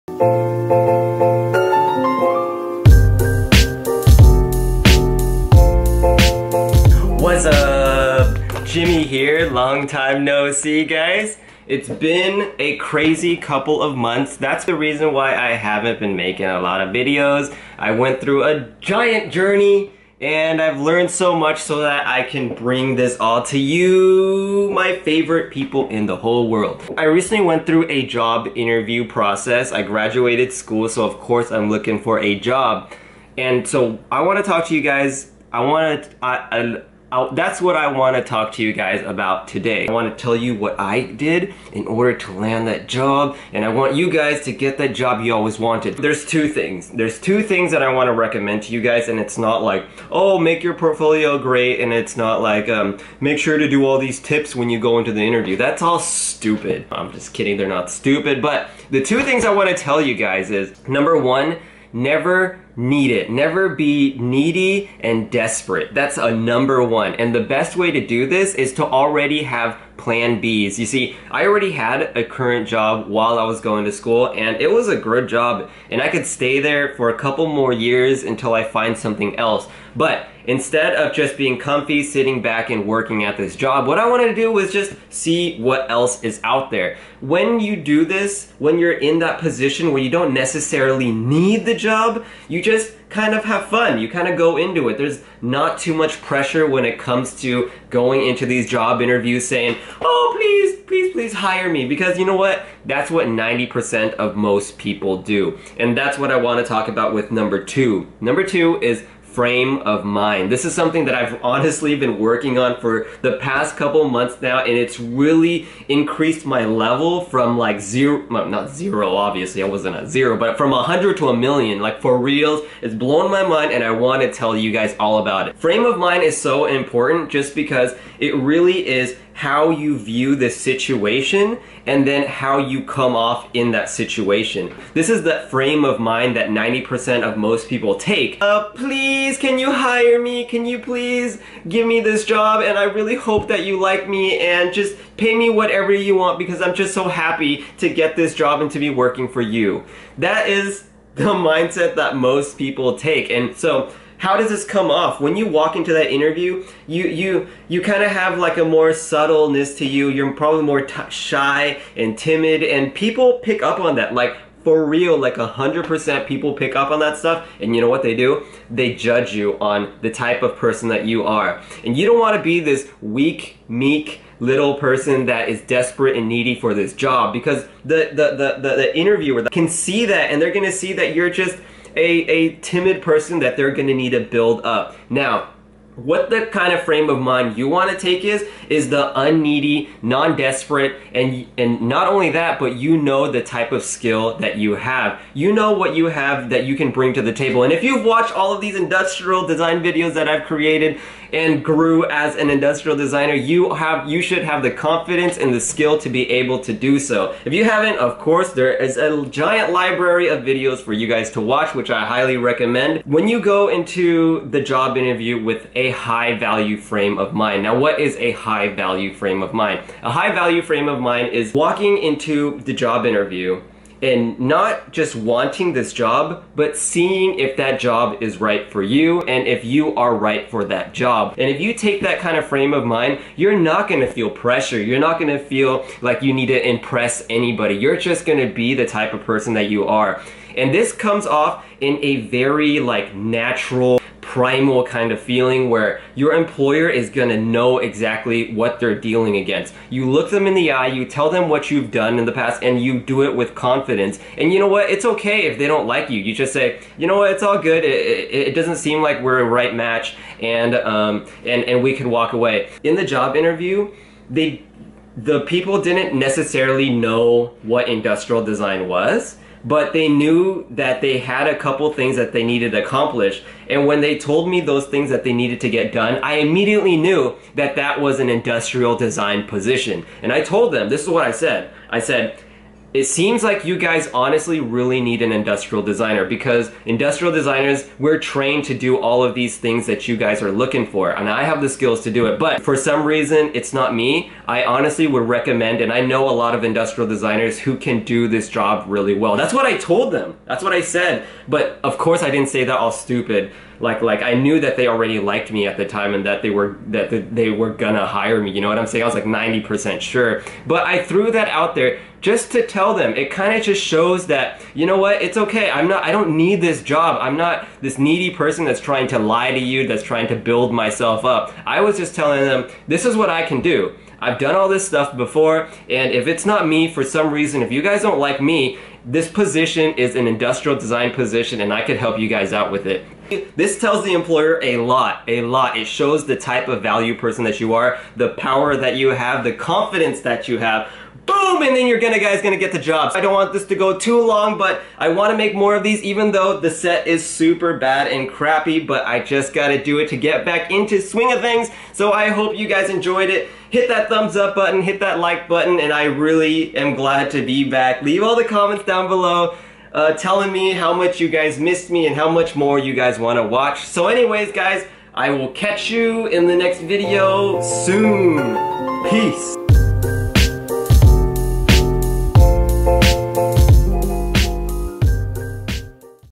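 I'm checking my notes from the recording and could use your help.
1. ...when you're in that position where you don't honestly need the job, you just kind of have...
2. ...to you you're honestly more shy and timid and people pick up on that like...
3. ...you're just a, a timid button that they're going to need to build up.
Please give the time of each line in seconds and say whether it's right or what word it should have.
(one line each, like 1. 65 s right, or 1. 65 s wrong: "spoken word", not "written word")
1. 88 s wrong: "necessarily", not "honestly"
2. 159 s wrong: "probably", not "honestly"
3. 181 s wrong: "person", not "button".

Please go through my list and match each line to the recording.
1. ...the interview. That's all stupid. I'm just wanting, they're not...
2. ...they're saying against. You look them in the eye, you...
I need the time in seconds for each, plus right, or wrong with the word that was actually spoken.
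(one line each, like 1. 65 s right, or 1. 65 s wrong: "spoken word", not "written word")
1. 55 s wrong: "kidding", not "wanting"
2. 248 s wrong: "dealing", not "saying".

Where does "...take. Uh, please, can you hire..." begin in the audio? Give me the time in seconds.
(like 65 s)
137 s.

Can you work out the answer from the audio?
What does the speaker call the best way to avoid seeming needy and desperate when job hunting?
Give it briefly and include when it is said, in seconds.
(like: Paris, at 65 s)
Plan Bs, at 70 s.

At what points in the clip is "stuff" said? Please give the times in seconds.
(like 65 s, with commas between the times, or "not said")
167 s, 324 s.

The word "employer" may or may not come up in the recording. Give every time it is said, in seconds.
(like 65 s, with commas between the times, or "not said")
246 s, 334 s.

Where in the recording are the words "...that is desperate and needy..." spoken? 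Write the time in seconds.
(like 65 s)
175 s.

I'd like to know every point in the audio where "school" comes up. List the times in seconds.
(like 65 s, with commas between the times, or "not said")
30 s, 73 s.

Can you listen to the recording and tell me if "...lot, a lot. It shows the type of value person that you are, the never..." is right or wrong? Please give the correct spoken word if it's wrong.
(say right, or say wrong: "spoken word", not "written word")
wrong: "power", not "never".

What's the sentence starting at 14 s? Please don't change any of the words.
That's the reason why I haven't been making a lot of videos.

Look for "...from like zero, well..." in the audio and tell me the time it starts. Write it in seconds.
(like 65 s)
117 s.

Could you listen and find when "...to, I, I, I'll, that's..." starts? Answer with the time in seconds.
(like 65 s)
36 s.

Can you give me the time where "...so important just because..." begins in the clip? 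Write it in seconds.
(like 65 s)
126 s.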